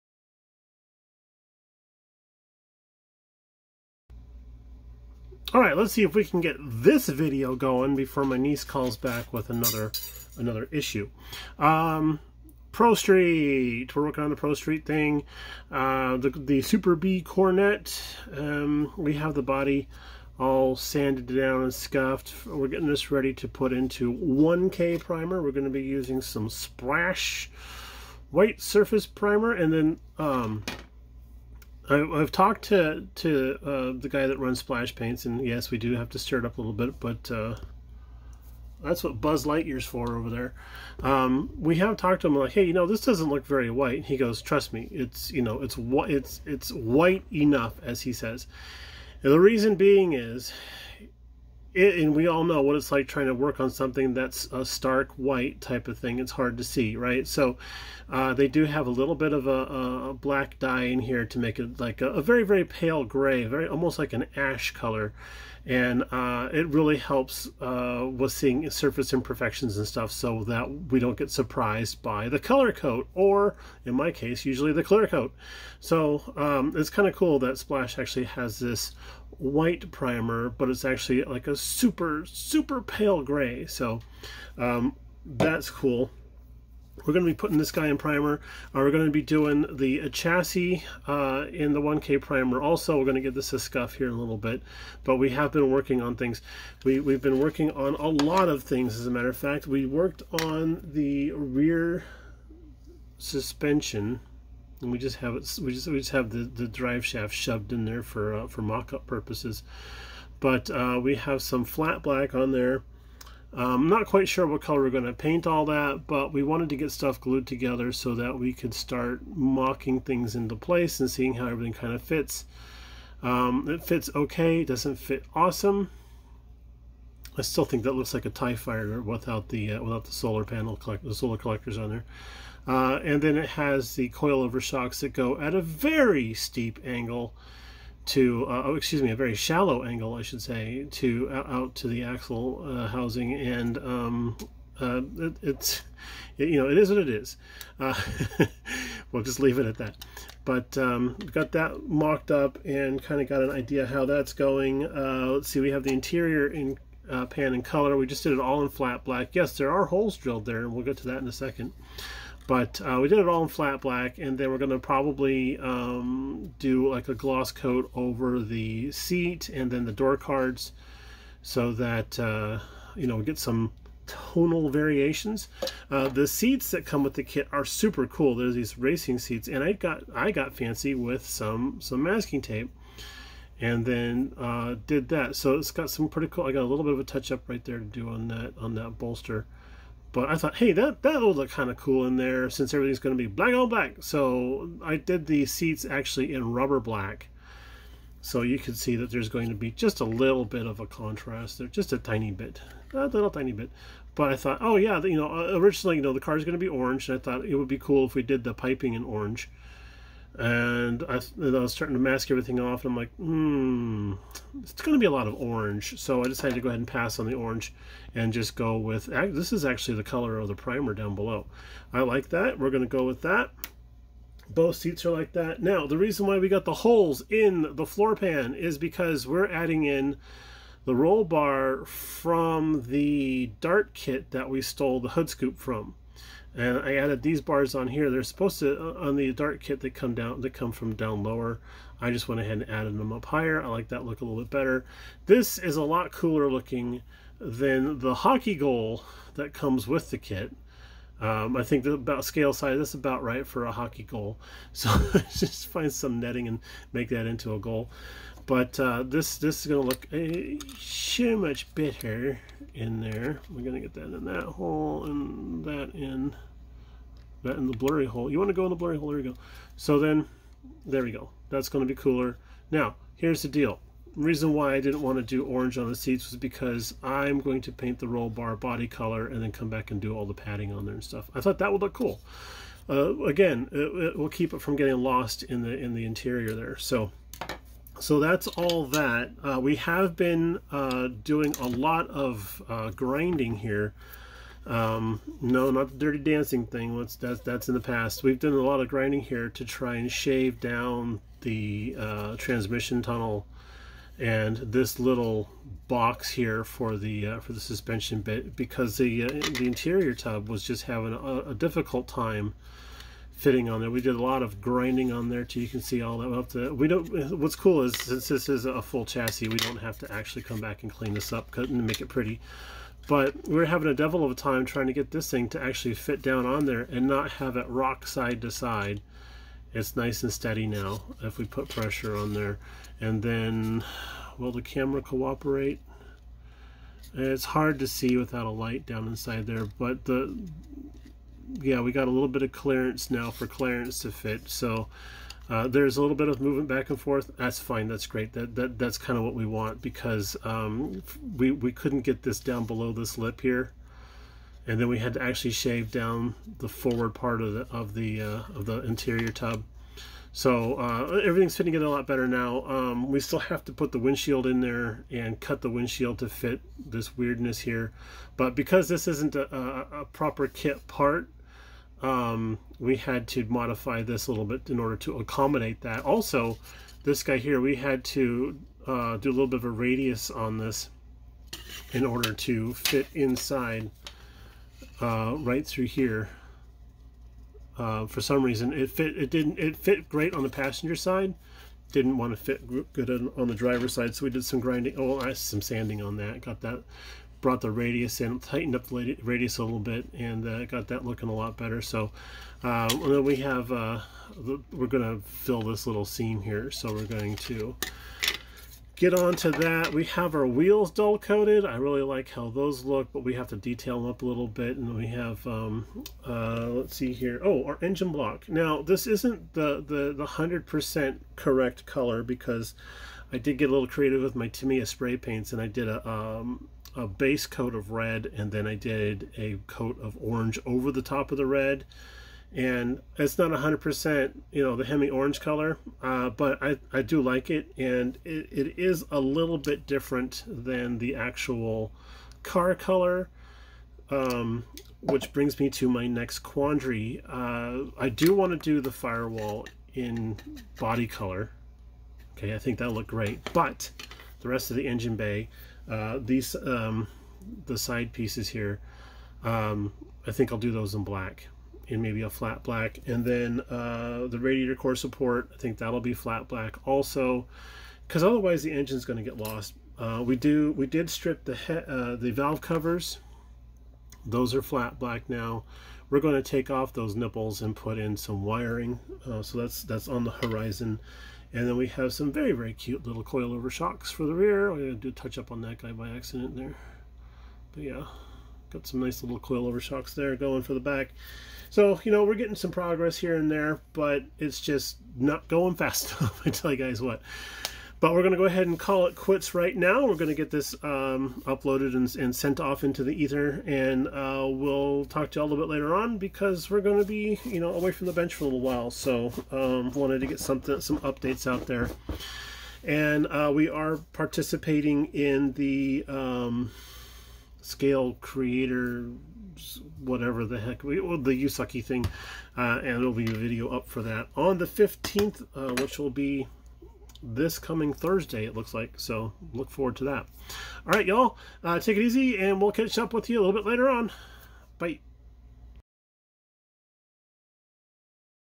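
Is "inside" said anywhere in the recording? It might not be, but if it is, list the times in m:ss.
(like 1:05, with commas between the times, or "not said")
5:39, 6:23.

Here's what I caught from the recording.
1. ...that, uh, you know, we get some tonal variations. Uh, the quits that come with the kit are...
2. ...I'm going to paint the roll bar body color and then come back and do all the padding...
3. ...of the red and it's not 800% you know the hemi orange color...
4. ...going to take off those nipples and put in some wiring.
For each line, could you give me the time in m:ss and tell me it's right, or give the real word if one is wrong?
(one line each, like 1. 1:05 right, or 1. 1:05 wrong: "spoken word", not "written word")
1. 2:51 wrong: "seats", not "quits"
2. 4:37 right
3. 7:11 wrong: "100", not "800"
4. 7:56 right.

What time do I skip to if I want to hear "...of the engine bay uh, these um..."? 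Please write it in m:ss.
7:34.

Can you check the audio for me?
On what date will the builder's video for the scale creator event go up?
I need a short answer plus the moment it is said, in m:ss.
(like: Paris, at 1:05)
the 15th, at 8:44.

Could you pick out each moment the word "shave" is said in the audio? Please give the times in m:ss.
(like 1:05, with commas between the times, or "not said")
5:00, 5:55.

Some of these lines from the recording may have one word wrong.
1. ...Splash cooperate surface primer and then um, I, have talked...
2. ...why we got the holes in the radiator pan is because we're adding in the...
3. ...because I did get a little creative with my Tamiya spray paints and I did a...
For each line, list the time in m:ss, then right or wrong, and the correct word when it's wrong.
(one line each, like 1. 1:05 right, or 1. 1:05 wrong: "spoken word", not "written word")
1. 0:26 wrong: "white", not "cooperate"
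2. 3:46 wrong: "floor", not "radiator"
3. 7:02 right.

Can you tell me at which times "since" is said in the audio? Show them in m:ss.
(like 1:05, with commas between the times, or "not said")
3:12, 5:17.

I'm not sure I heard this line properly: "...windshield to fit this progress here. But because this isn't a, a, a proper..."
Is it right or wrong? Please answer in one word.
wrong.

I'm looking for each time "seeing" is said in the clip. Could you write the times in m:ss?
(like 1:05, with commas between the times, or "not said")
1:08, 2:01.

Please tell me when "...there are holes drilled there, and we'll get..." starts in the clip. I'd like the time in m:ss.
2:39.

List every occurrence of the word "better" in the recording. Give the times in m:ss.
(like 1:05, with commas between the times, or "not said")
4:04, 4:21, 6:02, 6:41.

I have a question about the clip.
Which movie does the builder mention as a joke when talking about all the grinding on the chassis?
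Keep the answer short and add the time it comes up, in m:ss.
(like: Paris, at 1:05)
Dirty Dancing, at 4:55.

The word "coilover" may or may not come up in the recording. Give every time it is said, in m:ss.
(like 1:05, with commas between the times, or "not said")
2:14, 8:03, 8:09.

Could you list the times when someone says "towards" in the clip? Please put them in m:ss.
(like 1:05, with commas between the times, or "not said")
not said.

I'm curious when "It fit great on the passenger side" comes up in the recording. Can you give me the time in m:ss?
6:29.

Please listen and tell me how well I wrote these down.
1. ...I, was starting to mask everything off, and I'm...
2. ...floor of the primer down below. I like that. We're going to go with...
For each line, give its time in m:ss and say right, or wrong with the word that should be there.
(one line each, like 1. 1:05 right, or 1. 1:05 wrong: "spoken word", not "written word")
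1. 3:31 right
2. 3:40 wrong: "color", not "floor".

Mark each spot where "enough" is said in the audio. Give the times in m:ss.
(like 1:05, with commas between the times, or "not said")
0:47, 8:16.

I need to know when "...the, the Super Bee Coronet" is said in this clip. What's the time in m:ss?
0:16.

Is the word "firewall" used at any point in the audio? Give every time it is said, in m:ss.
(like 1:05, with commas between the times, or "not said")
7:28.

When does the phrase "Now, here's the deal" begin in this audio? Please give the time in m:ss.
4:32.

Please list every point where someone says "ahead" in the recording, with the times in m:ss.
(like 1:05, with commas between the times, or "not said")
3:36, 4:02, 8:18.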